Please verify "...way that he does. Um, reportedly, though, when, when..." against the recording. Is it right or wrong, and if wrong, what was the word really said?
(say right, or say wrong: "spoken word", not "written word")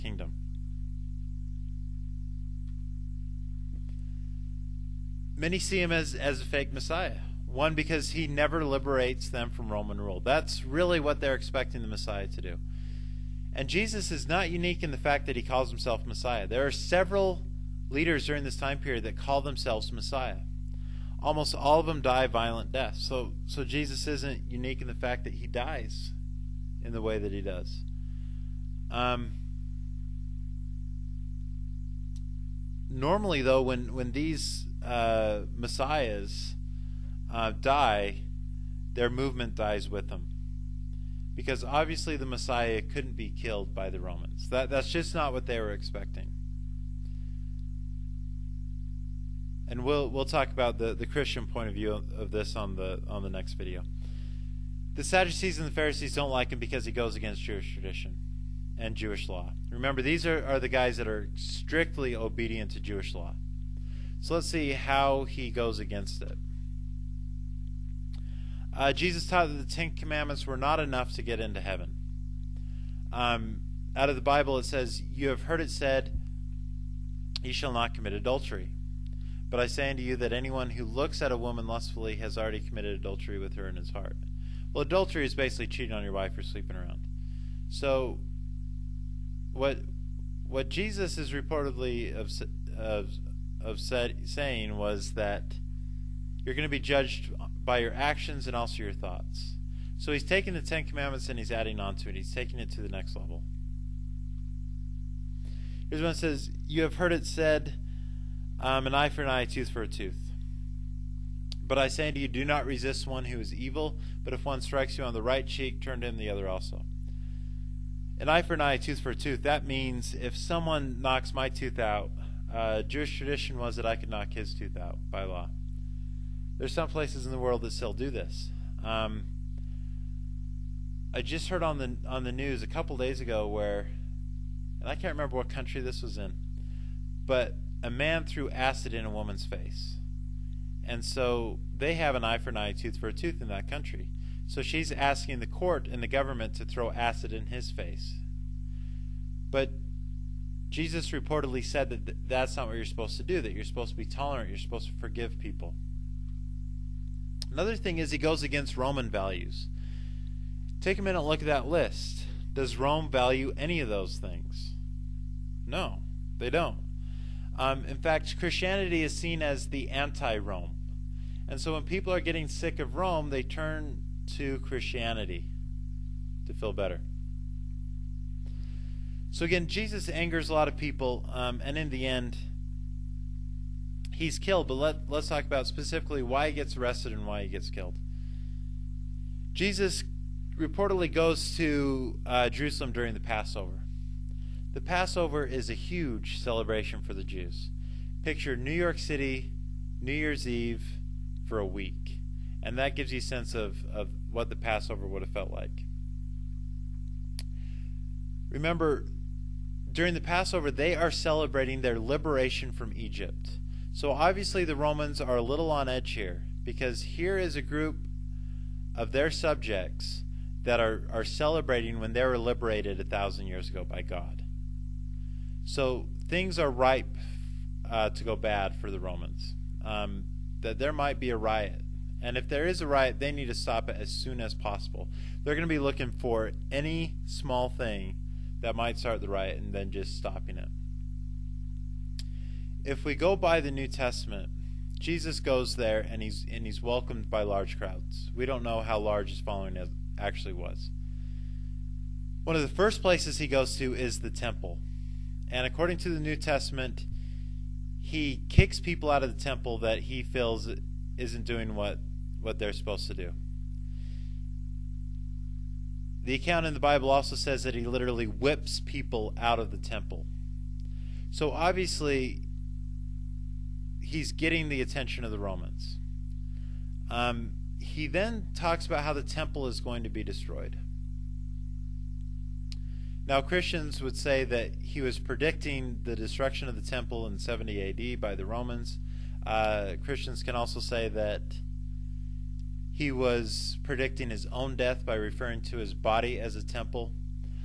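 wrong: "normally", not "reportedly".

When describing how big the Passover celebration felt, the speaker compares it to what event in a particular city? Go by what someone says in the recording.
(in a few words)
New York City New Year's Eve.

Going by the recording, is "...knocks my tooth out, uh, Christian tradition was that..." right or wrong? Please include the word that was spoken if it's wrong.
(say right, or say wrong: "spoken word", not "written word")
wrong: "Jewish", not "Christian".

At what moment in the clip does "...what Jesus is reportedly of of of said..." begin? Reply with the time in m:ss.
1:30.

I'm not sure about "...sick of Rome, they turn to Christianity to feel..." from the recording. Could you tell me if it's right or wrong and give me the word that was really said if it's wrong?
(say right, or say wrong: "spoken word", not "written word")
right.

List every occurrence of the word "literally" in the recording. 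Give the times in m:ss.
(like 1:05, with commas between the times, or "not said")
4:27.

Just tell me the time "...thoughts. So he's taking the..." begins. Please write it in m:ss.
1:38.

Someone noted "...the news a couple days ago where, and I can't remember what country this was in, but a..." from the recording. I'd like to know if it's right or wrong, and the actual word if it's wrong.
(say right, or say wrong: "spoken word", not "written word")
right.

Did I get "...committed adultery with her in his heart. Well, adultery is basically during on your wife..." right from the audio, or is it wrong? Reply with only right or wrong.
wrong.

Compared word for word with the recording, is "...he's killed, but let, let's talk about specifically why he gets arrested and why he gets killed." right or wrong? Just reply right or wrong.
right.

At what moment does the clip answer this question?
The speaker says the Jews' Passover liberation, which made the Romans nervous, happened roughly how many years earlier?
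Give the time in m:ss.
3:42.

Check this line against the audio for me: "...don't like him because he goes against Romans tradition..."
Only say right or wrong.
wrong.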